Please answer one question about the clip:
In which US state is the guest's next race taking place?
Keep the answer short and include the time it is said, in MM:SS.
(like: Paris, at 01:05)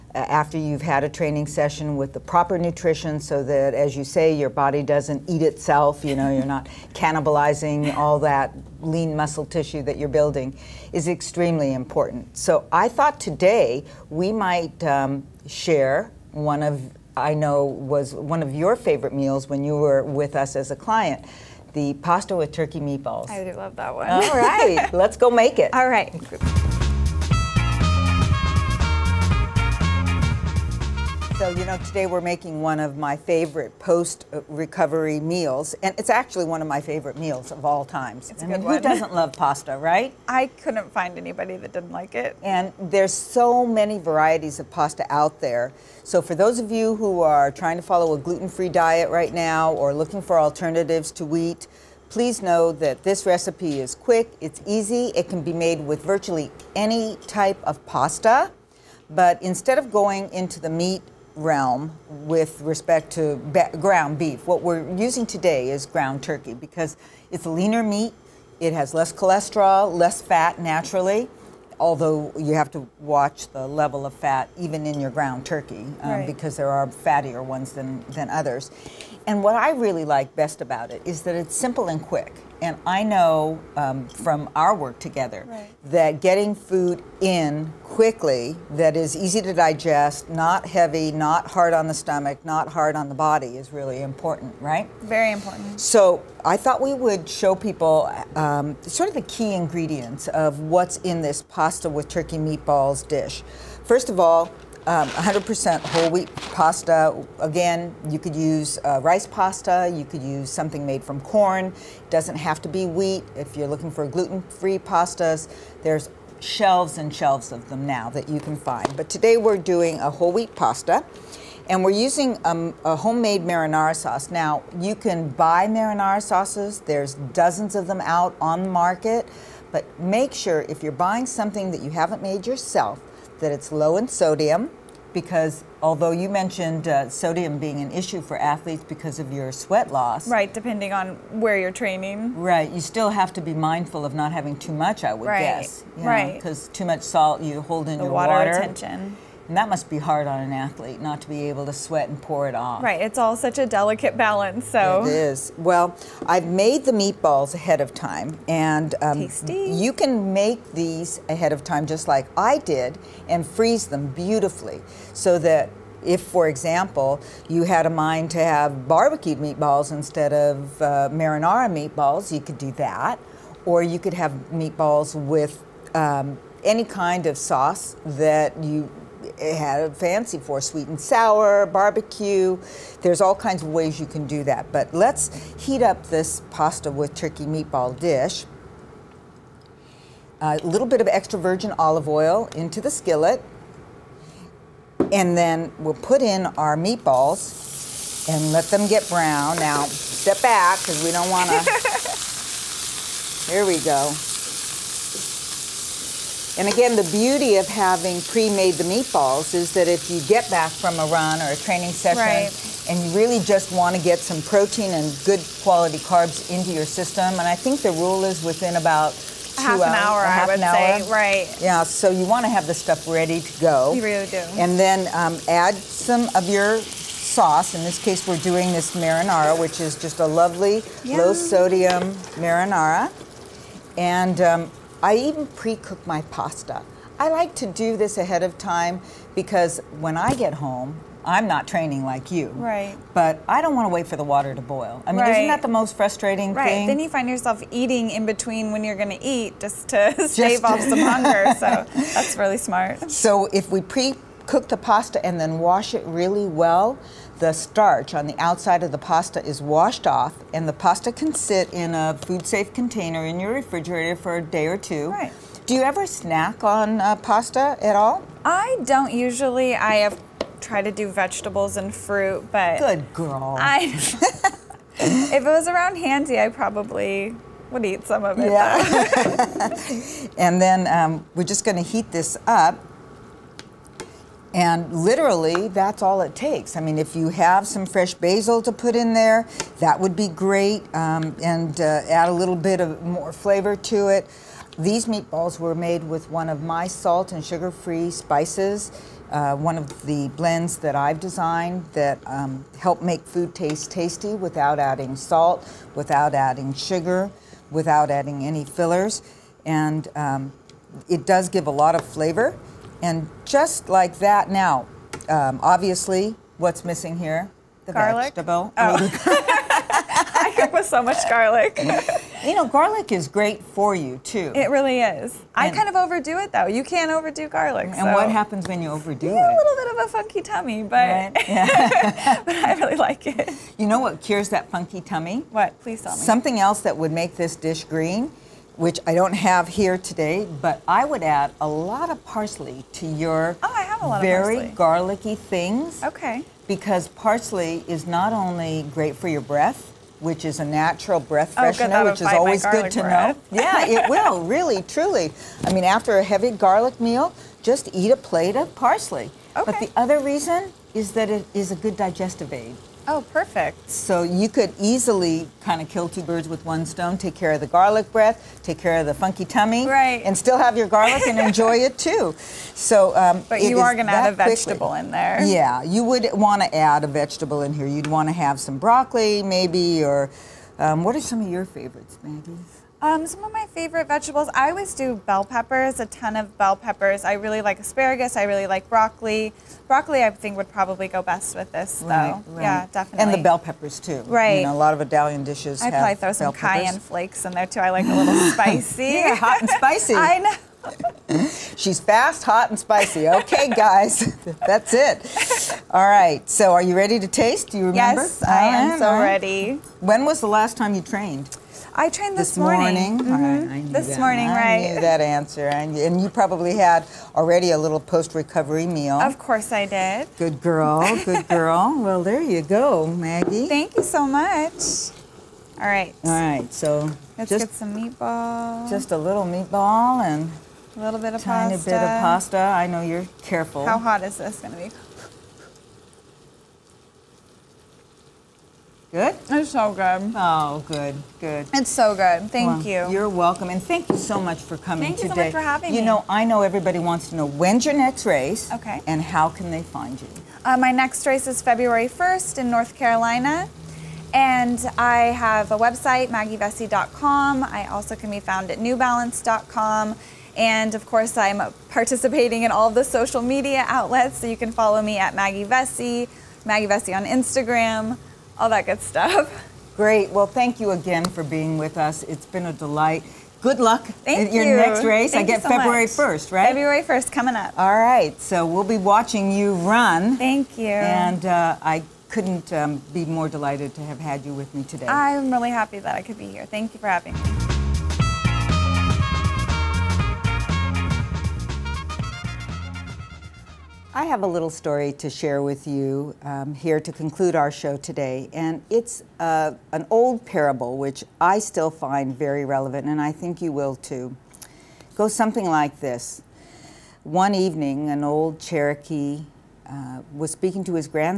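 North Carolina, at 07:32.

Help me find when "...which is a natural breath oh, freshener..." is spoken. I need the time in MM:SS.
05:50.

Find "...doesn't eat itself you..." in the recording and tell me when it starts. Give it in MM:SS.
00:04.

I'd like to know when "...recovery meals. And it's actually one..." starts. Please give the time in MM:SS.
00:34.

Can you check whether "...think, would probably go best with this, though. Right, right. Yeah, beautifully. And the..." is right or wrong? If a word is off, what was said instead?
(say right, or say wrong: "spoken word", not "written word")
wrong: "definitely", not "beautifully".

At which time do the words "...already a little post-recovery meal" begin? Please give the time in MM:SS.
06:57.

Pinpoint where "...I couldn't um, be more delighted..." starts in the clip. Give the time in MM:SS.
08:01.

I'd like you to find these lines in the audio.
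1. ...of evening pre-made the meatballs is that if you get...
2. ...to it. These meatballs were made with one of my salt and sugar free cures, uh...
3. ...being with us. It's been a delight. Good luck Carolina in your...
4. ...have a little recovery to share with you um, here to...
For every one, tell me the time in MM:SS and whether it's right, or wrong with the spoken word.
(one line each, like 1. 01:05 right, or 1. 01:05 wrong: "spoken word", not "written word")
1. 03:27 wrong: "having", not "evening"
2. 04:53 wrong: "spices", not "cures"
3. 07:51 wrong: "Thank", not "Carolina"
4. 08:14 wrong: "story", not "recovery".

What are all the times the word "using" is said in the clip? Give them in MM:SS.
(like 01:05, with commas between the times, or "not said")
01:04, 02:01.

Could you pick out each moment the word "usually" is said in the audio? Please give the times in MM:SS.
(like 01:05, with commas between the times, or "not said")
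04:29.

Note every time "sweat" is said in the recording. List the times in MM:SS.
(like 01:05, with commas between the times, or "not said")
02:19, 02:31.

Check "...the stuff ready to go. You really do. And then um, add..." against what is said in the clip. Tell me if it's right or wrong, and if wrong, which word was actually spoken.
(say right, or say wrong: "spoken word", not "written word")
right.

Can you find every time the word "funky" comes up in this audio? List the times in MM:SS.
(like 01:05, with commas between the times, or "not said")
05:30, 05:34, 06:09.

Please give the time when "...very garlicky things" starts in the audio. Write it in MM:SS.
05:44.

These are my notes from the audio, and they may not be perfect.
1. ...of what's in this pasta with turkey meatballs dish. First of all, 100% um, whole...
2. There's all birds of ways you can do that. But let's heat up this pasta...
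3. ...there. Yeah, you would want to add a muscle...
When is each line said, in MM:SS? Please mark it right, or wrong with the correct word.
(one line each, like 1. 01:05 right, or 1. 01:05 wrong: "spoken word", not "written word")
1. 01:40 right
2. 03:03 wrong: "kinds", not "birds"
3. 06:15 wrong: "vegetable", not "muscle".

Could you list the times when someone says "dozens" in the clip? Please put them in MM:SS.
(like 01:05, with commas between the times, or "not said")
02:07.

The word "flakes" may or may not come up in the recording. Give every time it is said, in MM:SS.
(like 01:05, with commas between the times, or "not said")
06:37.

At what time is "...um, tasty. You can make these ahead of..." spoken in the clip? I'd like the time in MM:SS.
02:39.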